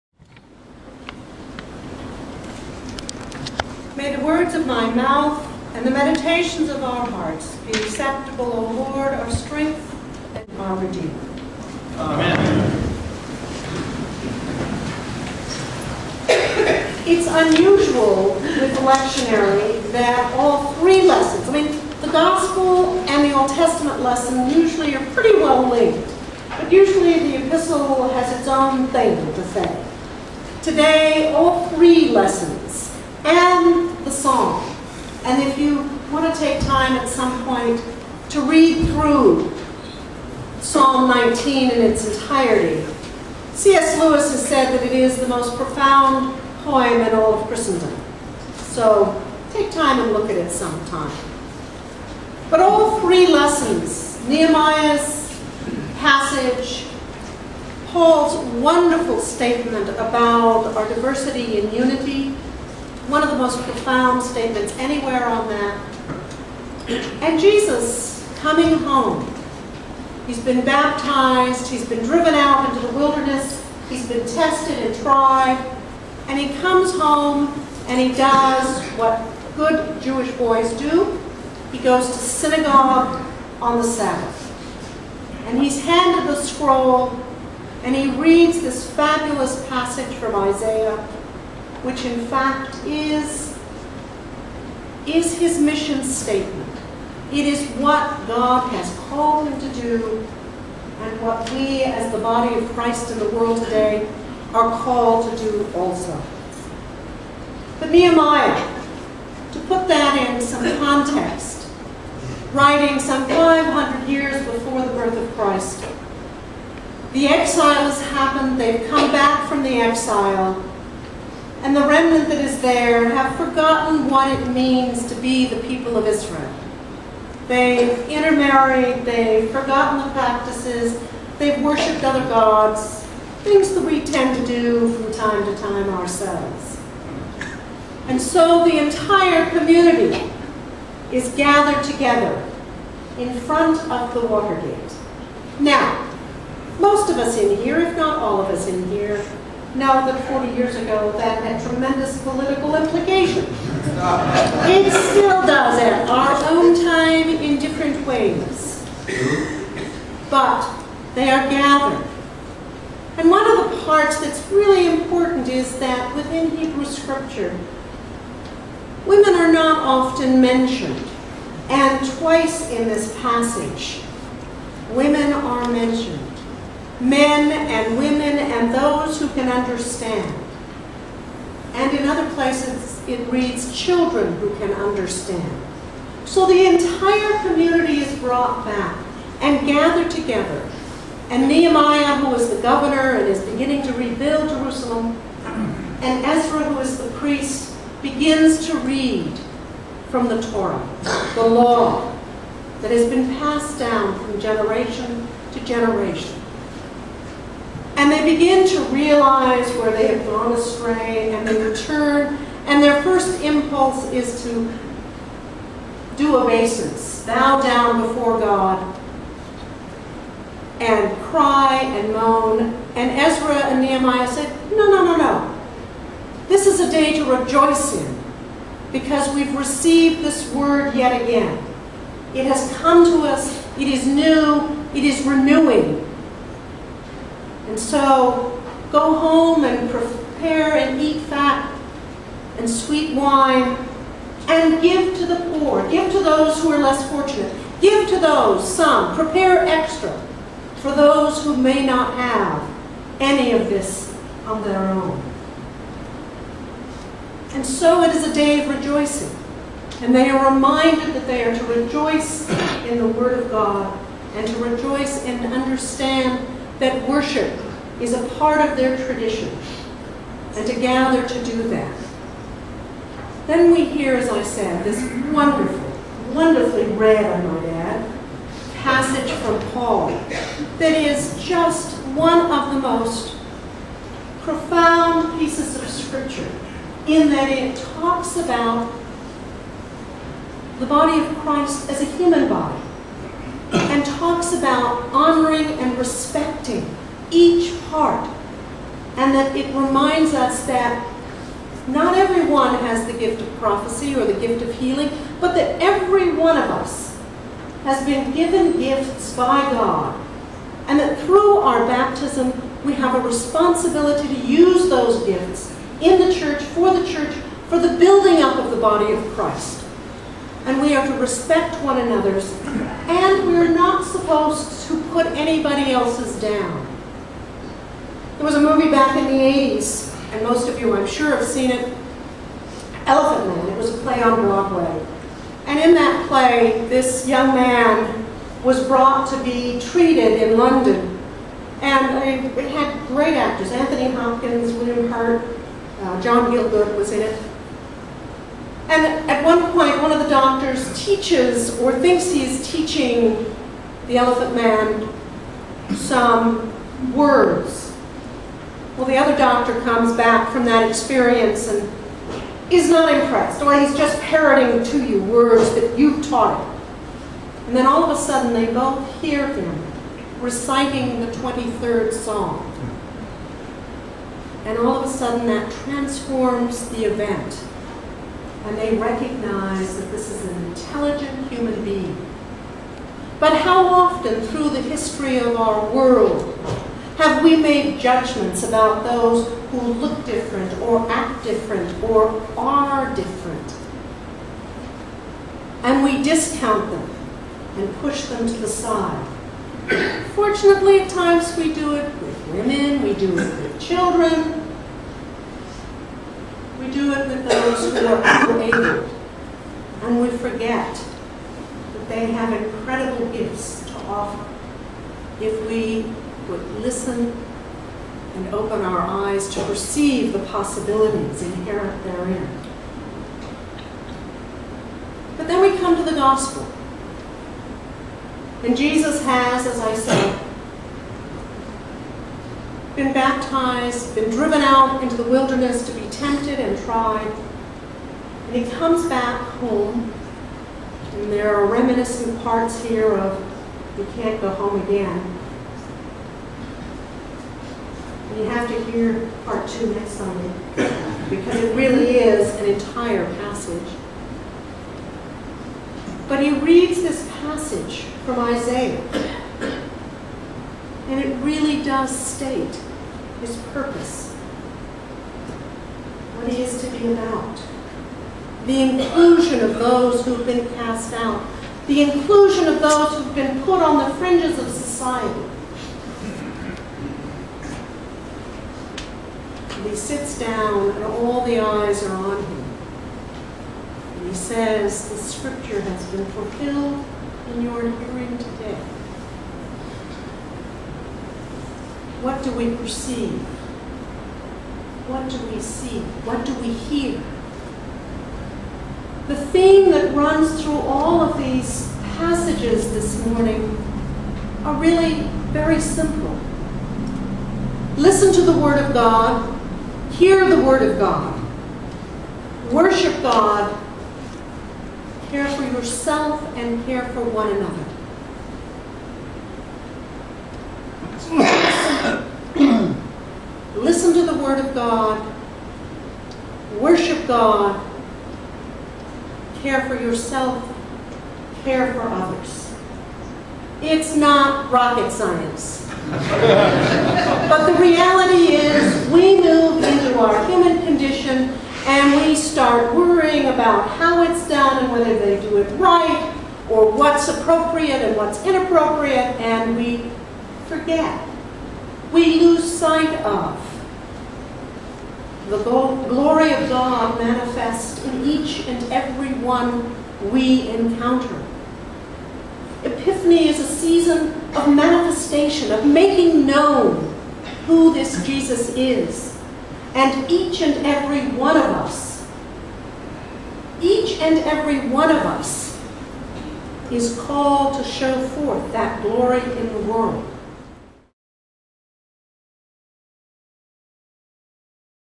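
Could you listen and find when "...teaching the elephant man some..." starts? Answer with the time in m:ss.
5:52.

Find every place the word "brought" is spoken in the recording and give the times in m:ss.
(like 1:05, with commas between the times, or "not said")
3:08, 5:38.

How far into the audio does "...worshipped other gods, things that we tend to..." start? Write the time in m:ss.
2:11.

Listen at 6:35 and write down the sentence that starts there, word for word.
And we discount them and push them to the side.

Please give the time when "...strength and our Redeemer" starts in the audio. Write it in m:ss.
0:09.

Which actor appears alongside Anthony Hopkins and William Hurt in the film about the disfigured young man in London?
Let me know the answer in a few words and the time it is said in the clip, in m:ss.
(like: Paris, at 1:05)
John Gielgud, at 5:46.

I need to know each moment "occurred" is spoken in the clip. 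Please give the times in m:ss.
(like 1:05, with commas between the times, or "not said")
not said.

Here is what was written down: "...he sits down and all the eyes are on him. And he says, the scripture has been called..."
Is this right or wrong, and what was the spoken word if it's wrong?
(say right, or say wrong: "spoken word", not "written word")
wrong: "fulfilled", not "called".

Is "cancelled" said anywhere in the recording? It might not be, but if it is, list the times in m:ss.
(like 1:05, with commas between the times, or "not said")
not said.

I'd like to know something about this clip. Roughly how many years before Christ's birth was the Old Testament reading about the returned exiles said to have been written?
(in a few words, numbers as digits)
500.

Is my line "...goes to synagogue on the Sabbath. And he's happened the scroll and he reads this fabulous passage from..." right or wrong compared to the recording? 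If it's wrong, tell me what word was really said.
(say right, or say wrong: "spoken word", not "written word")
wrong: "handed", not "happened".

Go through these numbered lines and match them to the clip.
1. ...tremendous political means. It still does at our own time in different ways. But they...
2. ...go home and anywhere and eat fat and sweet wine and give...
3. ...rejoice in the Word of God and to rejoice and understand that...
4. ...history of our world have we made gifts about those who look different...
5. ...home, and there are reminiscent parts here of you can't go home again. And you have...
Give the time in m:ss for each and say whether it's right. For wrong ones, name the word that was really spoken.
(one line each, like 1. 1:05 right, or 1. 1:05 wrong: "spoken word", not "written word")
1. 2:31 wrong: "implications", not "means"
2. 3:58 wrong: "prepare", not "anywhere"
3. 4:21 right
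4. 6:24 wrong: "judgments", not "gifts"
5. 7:19 right.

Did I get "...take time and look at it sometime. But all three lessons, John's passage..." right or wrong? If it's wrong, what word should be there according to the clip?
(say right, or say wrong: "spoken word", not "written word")
wrong: "Nehemiah", not "John".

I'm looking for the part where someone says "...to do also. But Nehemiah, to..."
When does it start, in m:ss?
1:45.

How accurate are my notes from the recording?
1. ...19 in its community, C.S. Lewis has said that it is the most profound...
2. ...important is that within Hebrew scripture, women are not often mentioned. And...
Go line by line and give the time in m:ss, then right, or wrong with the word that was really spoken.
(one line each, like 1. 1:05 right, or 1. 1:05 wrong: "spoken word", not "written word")
1. 0:41 wrong: "entirety", not "community"
2. 2:44 right.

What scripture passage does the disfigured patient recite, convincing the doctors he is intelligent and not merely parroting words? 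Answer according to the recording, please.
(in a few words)
the 23rd Psalm.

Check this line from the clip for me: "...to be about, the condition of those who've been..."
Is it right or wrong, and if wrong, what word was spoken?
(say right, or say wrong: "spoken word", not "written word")
wrong: "inclusion", not "condition".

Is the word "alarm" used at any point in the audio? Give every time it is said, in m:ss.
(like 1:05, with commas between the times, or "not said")
not said.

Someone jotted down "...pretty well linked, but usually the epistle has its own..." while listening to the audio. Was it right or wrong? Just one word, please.
right.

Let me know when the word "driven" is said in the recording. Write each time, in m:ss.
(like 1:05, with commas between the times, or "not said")
1:12, 7:14.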